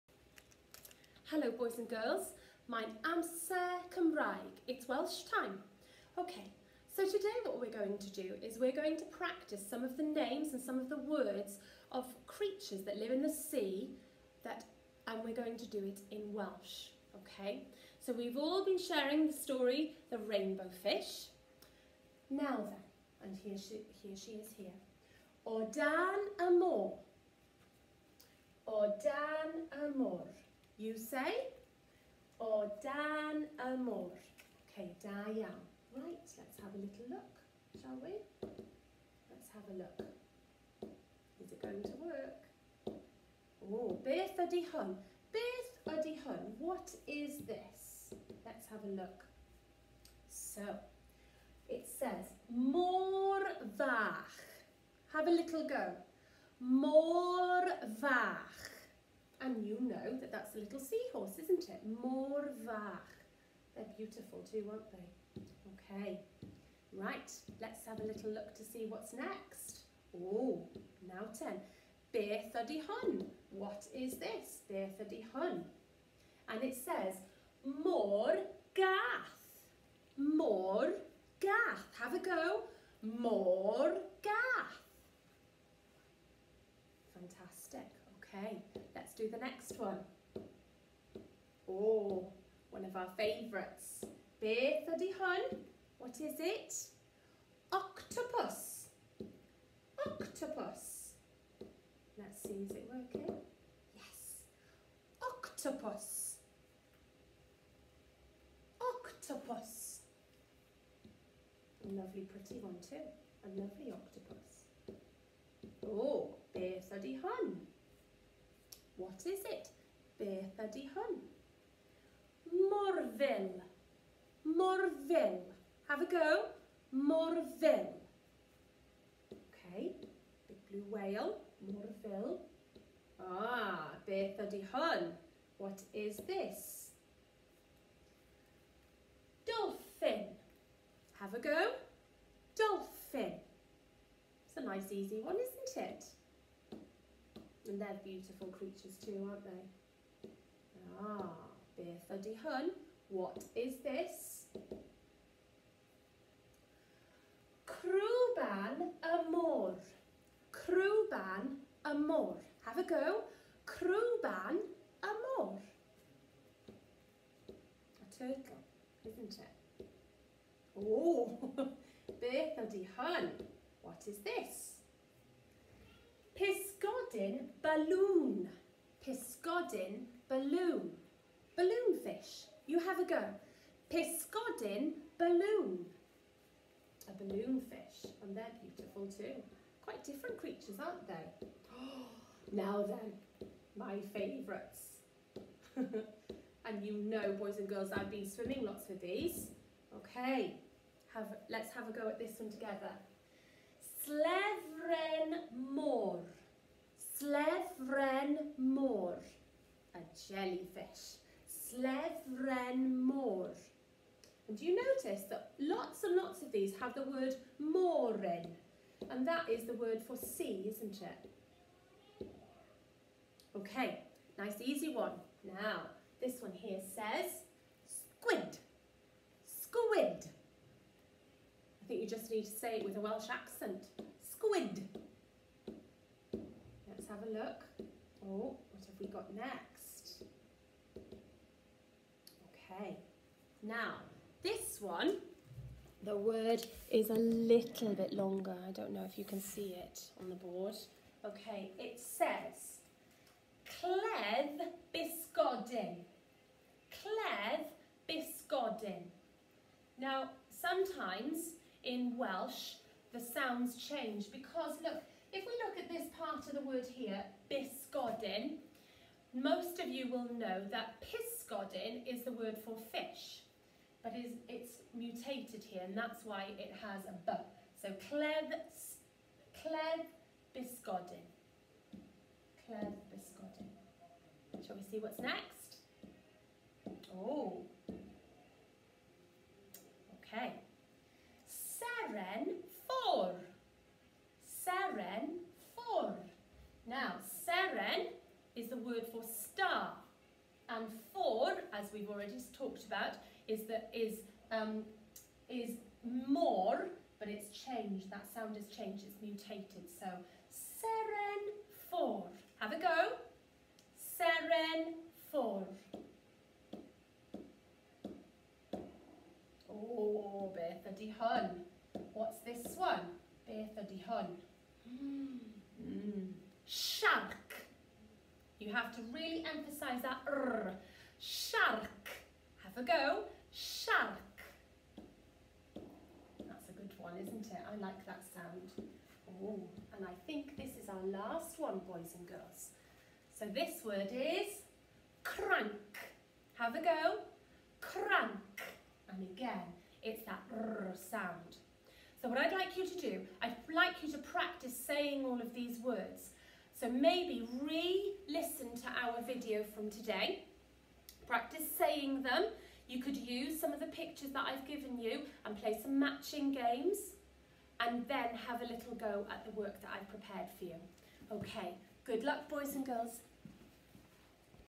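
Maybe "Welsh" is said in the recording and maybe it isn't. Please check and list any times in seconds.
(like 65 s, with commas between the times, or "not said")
4 s, 16 s, 233 s, 262 s.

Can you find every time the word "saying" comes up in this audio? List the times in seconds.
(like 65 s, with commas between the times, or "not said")
354 s, 361 s.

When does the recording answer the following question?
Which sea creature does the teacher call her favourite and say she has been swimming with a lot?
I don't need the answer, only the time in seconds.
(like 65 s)
209 s.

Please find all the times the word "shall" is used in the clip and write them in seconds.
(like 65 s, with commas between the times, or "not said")
37 s, 284 s.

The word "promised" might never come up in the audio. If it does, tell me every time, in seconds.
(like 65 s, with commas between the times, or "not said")
not said.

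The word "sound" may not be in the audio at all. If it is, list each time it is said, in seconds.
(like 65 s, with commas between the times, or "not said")
263 s, 308 s, 338 s, 351 s.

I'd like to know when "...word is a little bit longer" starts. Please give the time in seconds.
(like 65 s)
246 s.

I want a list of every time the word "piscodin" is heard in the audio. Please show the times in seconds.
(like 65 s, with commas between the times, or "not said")
179 s, 183 s.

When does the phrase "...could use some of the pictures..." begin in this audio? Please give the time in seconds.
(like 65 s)
363 s.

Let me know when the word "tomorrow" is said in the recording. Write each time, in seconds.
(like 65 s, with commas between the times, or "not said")
not said.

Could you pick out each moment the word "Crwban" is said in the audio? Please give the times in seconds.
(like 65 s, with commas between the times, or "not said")
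157 s, 163 s.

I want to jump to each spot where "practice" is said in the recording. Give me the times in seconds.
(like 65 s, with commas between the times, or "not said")
9 s, 354 s, 361 s.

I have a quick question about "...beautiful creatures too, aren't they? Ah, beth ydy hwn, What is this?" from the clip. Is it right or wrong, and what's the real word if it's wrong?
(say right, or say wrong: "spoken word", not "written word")
right.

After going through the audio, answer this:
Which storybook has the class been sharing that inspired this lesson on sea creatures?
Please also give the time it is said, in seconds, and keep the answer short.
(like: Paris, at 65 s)
The Rainbow Fish, at 20 s.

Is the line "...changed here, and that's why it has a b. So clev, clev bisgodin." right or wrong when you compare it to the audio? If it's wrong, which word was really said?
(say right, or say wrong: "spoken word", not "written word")
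wrong: "mutated", not "changed".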